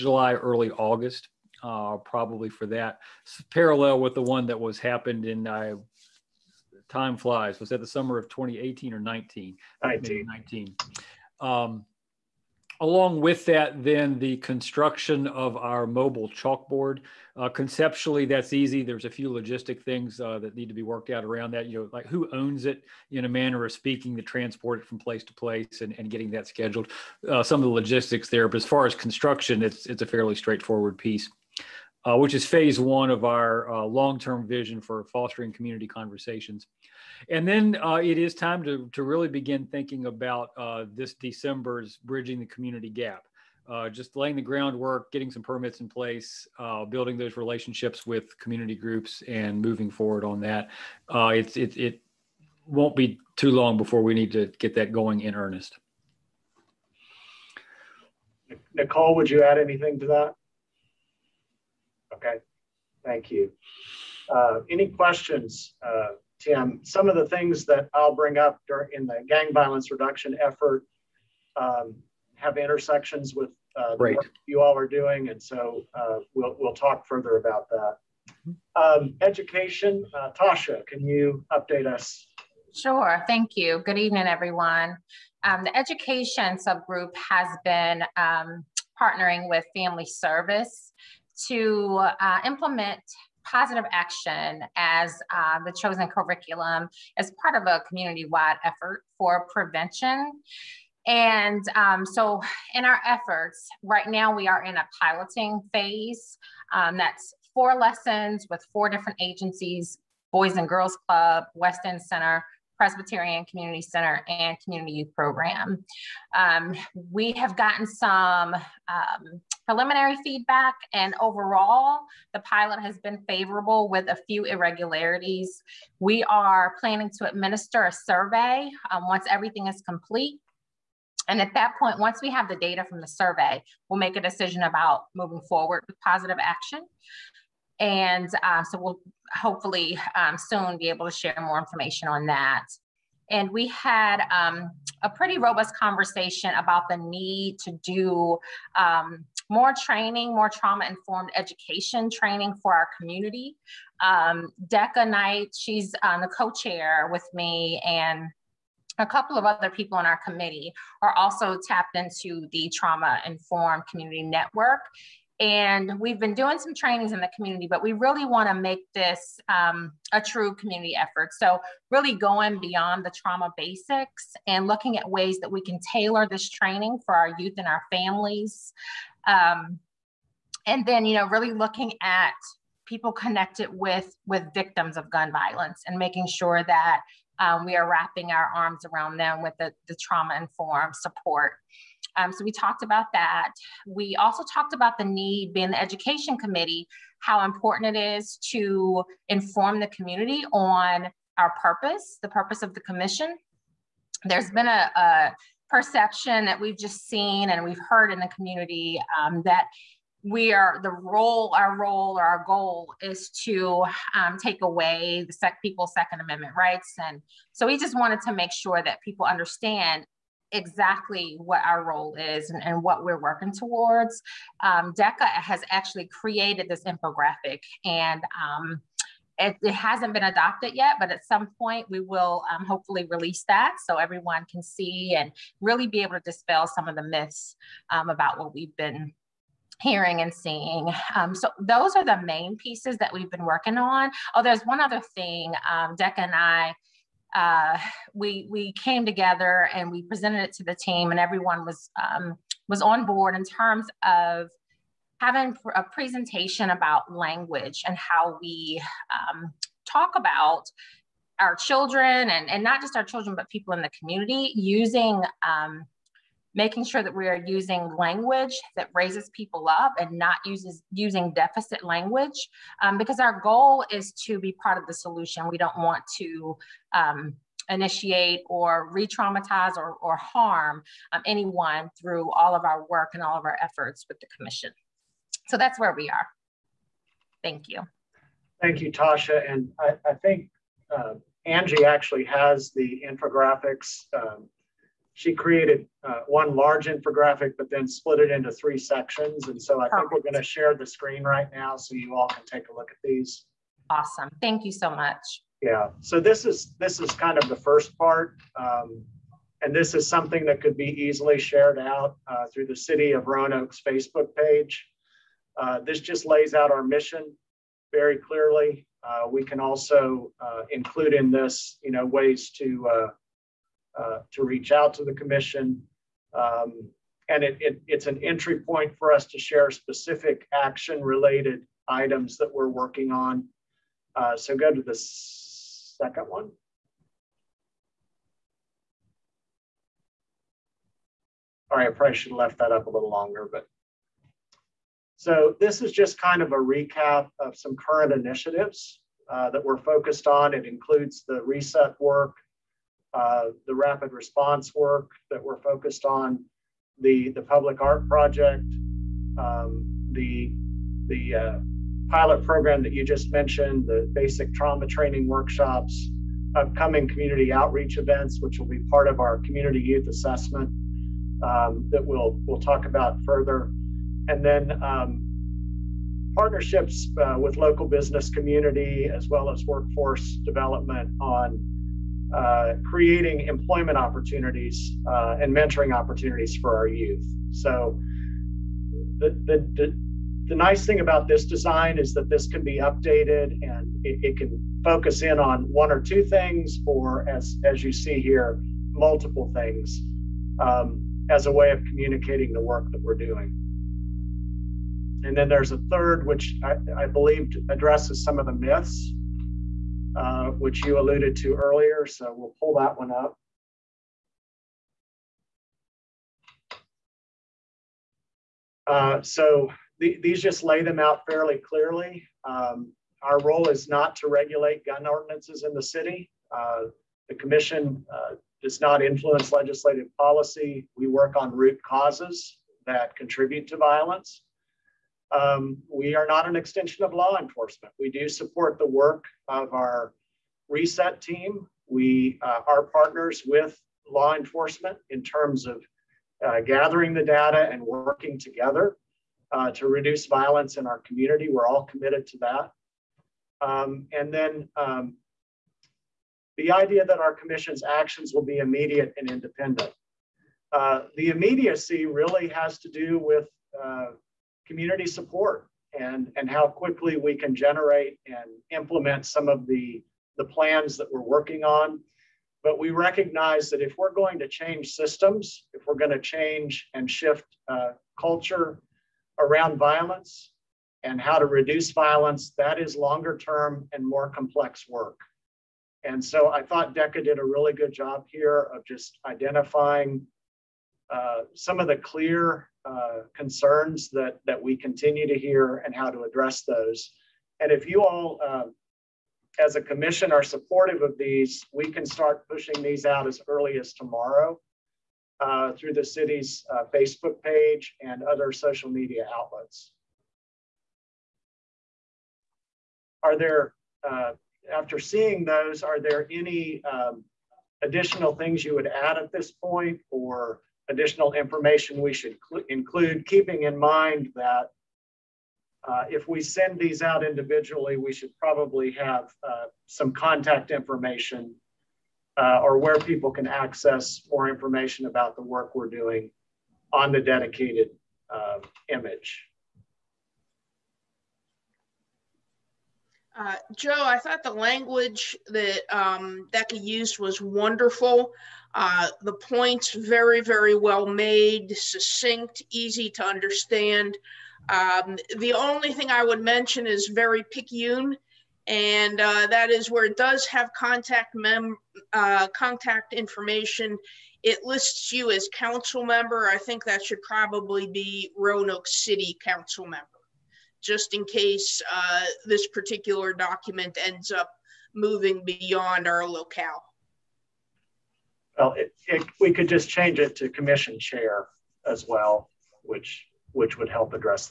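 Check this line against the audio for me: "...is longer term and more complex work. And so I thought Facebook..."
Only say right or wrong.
wrong.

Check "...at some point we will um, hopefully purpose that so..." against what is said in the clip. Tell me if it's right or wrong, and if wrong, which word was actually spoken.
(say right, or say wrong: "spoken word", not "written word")
wrong: "release", not "purpose".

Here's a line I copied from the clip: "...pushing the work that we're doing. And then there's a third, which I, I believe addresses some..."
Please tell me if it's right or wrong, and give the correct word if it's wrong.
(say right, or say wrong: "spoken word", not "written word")
wrong: "communicating", not "pushing".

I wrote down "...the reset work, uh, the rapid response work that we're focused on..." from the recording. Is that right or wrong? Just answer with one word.
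right.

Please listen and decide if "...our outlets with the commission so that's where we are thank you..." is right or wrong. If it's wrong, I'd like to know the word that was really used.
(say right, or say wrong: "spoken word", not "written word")
wrong: "efforts", not "outlets".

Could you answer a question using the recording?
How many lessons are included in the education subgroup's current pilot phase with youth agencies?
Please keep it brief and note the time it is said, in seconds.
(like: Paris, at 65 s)
4, at 107 s.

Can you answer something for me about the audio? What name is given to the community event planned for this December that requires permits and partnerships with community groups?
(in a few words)
Bridging the Community Gap.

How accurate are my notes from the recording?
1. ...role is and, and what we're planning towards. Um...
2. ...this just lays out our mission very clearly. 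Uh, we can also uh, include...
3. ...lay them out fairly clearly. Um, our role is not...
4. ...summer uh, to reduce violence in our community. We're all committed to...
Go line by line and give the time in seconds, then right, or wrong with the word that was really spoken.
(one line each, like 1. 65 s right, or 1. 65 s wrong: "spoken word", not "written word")
1. 221 s wrong: "working", not "planning"
2. 315 s right
3. 420 s right
4. 448 s wrong: "together", not "summer".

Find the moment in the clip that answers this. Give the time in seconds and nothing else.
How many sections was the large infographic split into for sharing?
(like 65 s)
298 s.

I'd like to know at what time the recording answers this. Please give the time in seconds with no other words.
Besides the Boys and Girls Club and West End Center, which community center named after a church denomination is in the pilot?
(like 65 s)
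112 s.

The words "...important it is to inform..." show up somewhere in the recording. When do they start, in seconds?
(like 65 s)
197 s.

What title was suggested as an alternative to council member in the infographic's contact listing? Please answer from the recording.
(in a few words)
Commission chair.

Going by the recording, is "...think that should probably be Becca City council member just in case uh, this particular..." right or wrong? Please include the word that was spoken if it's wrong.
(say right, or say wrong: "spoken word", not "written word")
wrong: "Roanoke", not "Becca".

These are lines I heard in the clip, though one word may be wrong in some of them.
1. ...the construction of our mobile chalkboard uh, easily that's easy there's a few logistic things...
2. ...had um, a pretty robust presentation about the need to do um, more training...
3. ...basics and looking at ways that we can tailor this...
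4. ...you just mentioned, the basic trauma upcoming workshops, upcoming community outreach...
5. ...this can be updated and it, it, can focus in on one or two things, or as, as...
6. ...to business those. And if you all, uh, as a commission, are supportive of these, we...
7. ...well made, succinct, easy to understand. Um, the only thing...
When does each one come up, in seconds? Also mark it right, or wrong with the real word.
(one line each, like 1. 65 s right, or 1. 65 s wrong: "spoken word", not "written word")
1. 14 s wrong: "conceptually", not "easily"
2. 143 s wrong: "conversation", not "presentation"
3. 173 s right
4. 362 s wrong: "training", not "upcoming"
5. 392 s right
6. 496 s wrong: "address", not "business"
7. 550 s right.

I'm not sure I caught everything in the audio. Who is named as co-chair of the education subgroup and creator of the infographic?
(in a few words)
Decca Knight.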